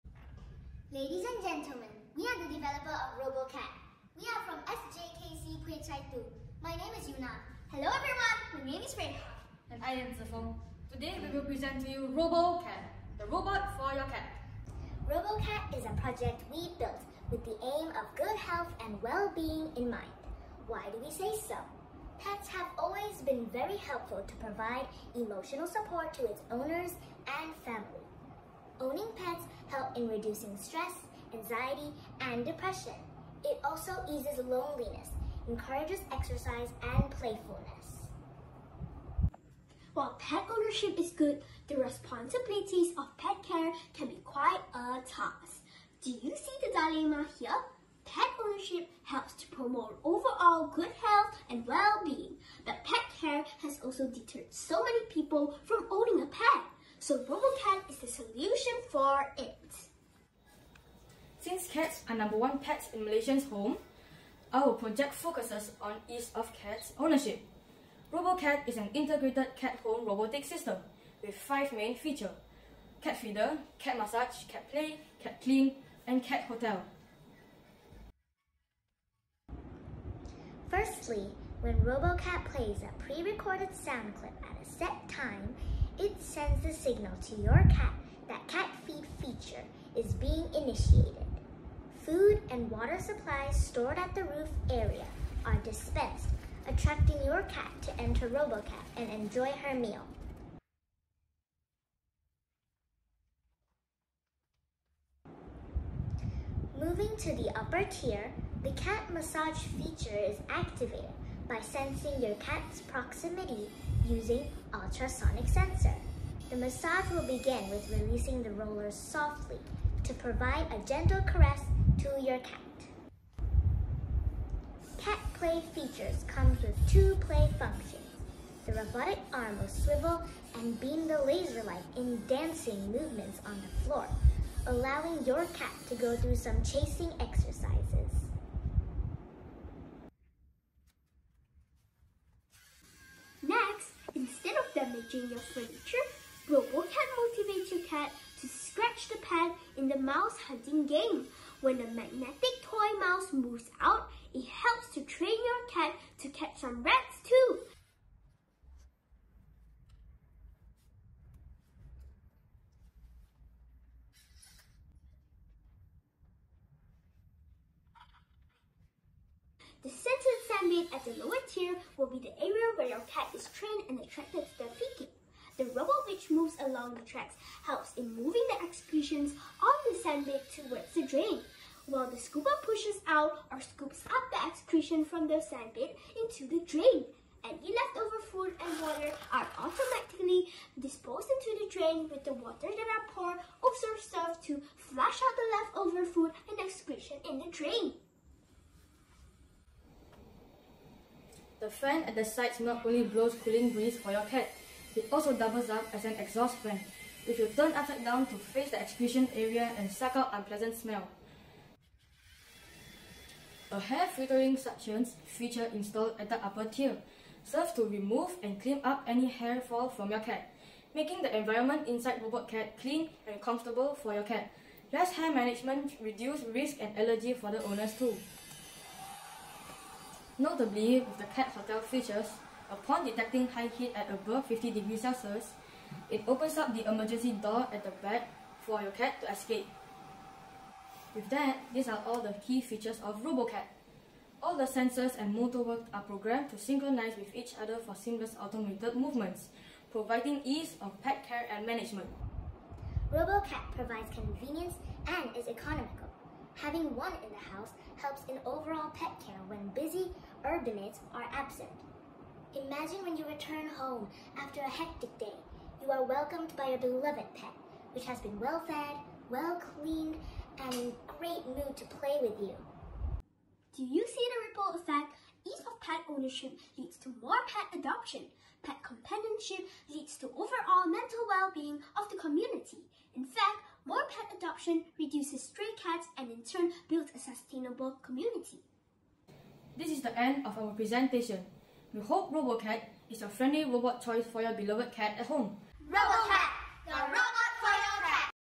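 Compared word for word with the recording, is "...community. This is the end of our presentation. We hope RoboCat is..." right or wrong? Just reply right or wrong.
right.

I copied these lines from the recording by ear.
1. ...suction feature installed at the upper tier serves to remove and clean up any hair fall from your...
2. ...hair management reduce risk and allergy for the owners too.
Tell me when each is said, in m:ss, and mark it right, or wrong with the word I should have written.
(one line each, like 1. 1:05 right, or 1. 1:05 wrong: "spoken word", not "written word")
1. 3:34 right
2. 3:45 right.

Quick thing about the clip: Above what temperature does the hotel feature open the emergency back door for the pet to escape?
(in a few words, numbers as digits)
50 degrees Celsius.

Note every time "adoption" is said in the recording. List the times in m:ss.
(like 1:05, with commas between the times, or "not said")
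4:37, 4:44.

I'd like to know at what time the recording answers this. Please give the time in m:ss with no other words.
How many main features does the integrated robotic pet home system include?
1:11.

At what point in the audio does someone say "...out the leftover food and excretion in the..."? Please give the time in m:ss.
3:15.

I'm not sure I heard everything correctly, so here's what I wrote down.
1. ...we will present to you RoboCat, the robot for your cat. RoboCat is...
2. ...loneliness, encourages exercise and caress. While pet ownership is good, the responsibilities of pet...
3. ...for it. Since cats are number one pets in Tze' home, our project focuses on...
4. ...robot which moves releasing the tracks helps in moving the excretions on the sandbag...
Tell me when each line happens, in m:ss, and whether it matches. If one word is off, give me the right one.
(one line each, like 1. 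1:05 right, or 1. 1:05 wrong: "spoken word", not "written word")
1. 0:11 right
2. 0:34 wrong: "playfulness", not "caress"
3. 0:58 wrong: "Malaysians", not "Tze"
4. 2:55 wrong: "along", not "releasing".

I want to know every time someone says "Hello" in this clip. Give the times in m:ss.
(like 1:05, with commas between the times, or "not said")
0:07.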